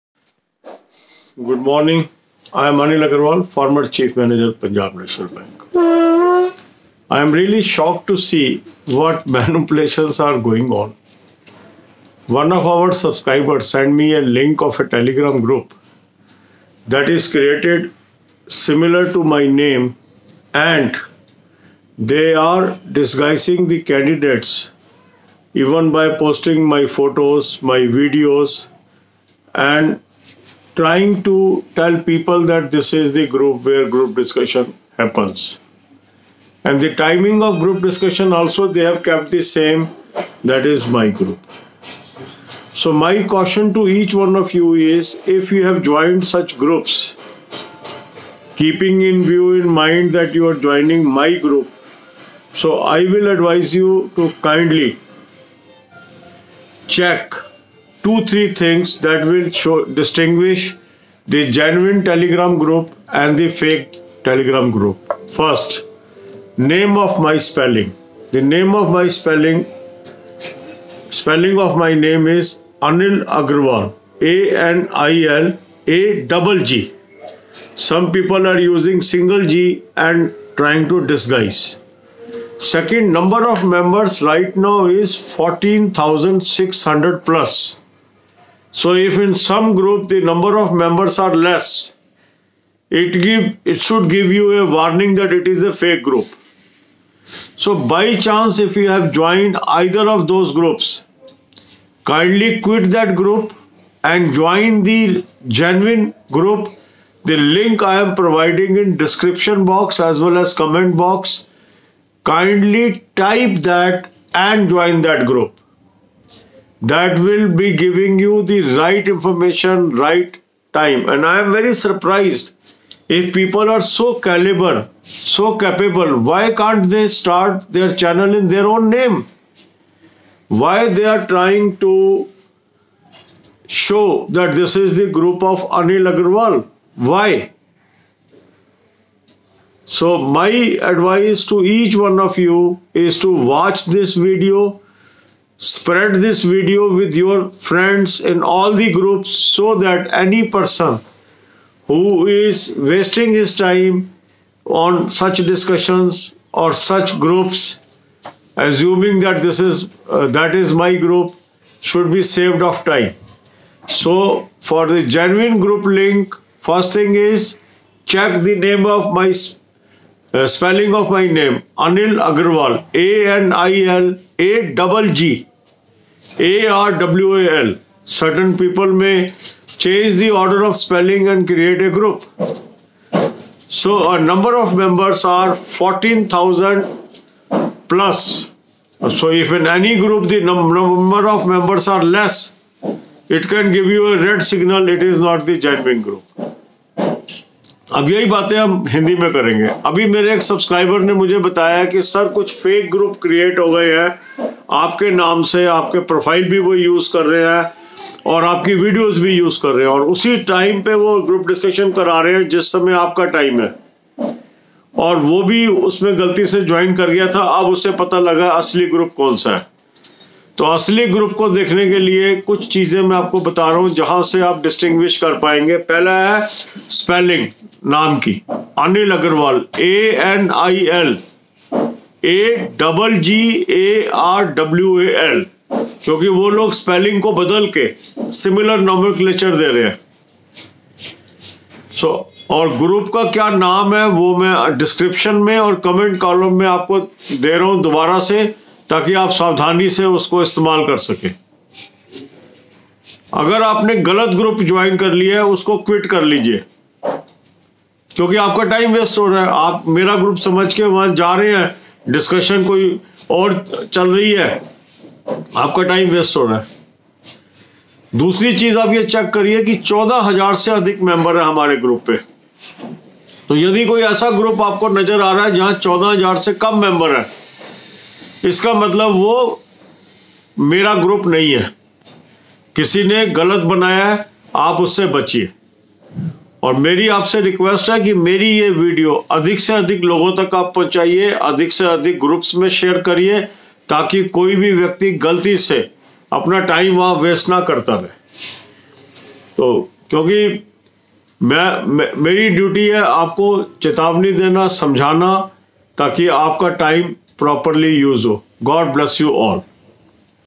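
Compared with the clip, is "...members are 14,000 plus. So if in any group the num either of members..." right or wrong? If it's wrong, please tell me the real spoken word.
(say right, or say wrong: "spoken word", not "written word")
wrong: "number", not "either".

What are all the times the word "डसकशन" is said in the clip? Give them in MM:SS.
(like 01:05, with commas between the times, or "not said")
03:31, 04:22.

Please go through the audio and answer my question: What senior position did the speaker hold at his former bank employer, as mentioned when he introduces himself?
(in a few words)
Chief Manager.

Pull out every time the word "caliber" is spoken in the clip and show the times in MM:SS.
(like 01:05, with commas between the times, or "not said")
02:04.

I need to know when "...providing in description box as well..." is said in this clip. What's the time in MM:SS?
01:48.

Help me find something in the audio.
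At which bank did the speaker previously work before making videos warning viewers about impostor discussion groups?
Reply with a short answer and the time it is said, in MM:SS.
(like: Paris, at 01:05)
Punjab National Bank, at 00:04.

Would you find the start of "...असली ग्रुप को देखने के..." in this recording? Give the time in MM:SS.
03:40.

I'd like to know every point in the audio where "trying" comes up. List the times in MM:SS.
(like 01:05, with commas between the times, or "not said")
00:30, 01:20, 02:11.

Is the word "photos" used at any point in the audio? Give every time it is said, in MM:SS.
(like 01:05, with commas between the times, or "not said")
00:26.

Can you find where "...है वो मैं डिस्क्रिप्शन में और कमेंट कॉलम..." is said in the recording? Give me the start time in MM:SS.
04:03.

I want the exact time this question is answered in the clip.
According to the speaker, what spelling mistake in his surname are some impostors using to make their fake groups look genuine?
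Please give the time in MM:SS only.
01:18.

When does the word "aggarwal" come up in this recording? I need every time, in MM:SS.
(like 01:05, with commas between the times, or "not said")
00:03, 01:13, 02:16, 02:52.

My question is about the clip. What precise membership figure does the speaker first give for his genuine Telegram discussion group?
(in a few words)
14600 plus.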